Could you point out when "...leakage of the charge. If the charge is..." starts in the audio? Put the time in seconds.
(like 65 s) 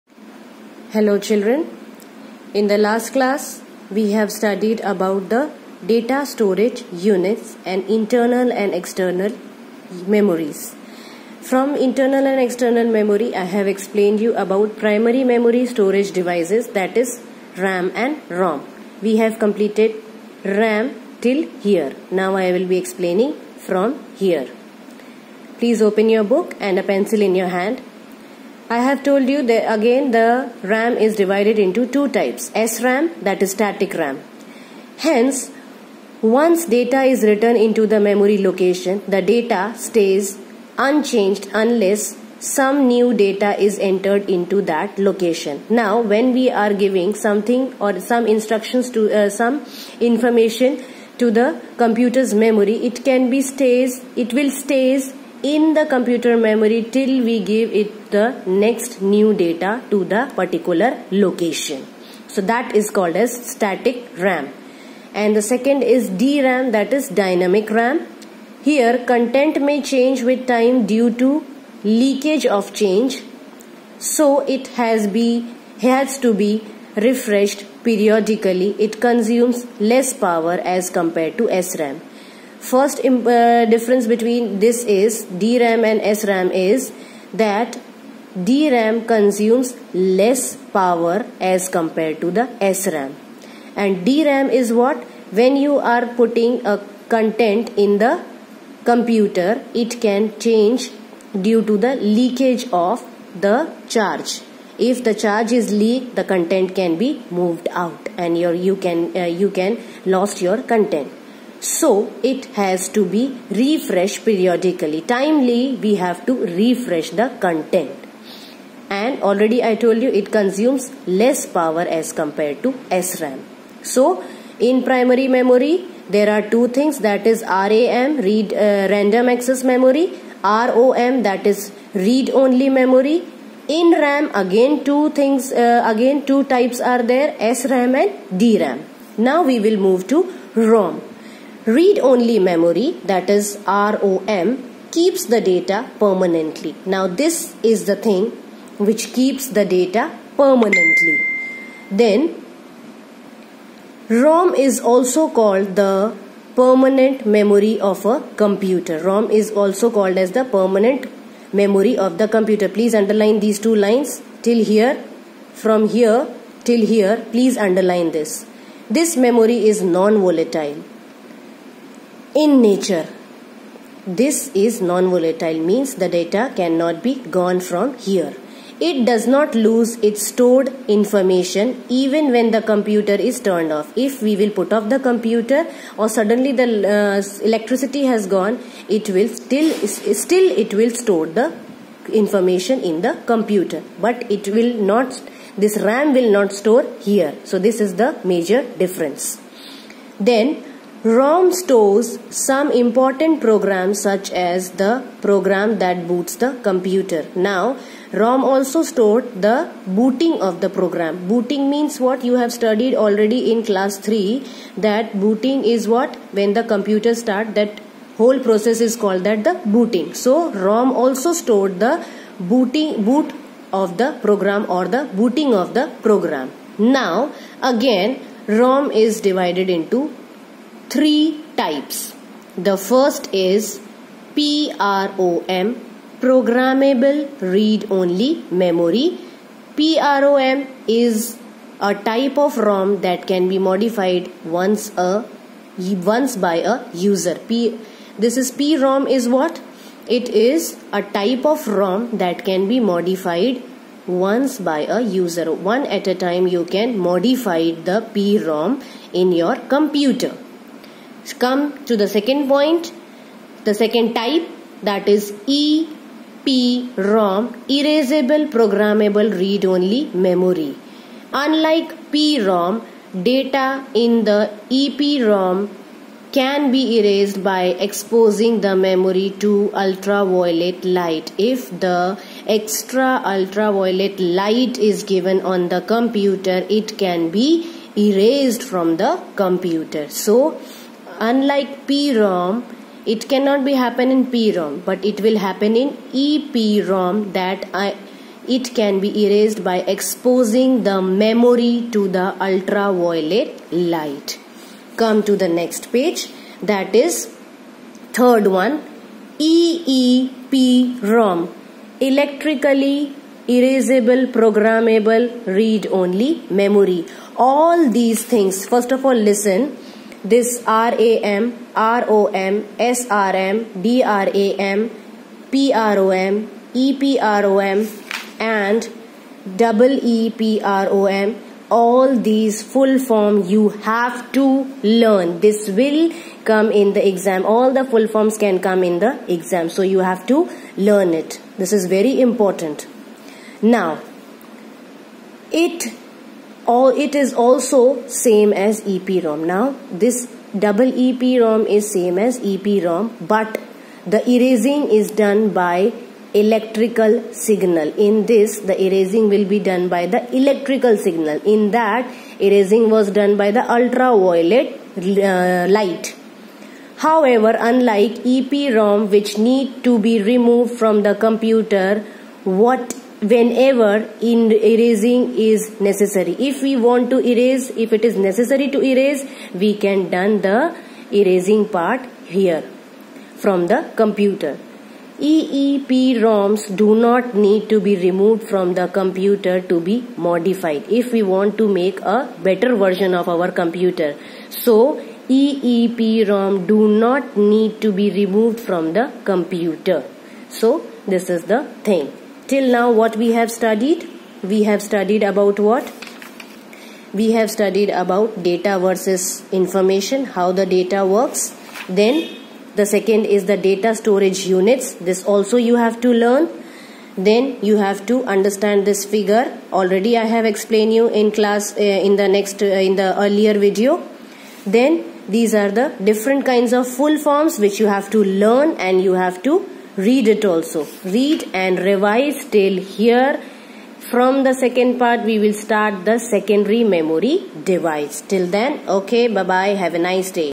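101 s.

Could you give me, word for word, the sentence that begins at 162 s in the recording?
Please underline these two lines till here.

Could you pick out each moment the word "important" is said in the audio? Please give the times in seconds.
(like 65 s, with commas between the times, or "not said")
202 s, 342 s.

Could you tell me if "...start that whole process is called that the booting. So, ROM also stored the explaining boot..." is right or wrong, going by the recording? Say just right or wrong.
wrong.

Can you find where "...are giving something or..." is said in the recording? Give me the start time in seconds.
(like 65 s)
46 s.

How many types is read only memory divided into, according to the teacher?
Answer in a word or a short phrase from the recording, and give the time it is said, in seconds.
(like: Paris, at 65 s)
Three, at 230 s.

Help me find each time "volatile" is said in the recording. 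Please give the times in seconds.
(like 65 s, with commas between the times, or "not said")
169 s, 174 s.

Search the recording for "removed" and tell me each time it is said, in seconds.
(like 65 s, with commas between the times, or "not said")
370 s, 387 s, 398 s.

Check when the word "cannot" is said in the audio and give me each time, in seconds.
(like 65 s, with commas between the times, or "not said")
176 s, 293 s.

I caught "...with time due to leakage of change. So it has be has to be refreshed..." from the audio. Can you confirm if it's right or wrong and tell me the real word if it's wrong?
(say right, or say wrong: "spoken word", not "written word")
right.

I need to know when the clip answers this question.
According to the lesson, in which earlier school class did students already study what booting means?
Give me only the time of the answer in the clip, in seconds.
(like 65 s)
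213 s.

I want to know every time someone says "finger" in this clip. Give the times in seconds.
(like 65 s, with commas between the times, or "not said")
not said.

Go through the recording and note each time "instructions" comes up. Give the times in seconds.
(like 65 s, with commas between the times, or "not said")
48 s.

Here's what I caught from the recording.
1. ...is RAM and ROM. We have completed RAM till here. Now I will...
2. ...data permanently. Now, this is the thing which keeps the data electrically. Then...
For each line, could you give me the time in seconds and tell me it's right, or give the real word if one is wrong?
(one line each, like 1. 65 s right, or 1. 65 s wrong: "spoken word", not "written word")
1. 16 s right
2. 145 s wrong: "permanently", not "electrically".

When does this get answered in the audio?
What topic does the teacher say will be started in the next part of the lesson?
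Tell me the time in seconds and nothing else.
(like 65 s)
436 s.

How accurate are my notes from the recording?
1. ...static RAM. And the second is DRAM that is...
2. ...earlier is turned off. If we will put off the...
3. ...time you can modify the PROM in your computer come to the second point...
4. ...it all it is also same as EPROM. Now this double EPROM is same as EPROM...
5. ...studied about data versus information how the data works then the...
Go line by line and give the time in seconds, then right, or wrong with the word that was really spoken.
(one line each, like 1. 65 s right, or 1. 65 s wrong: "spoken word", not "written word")
1. 63 s right
2. 182 s wrong: "computer", not "earlier"
3. 256 s right
4. 345 s right
5. 407 s right.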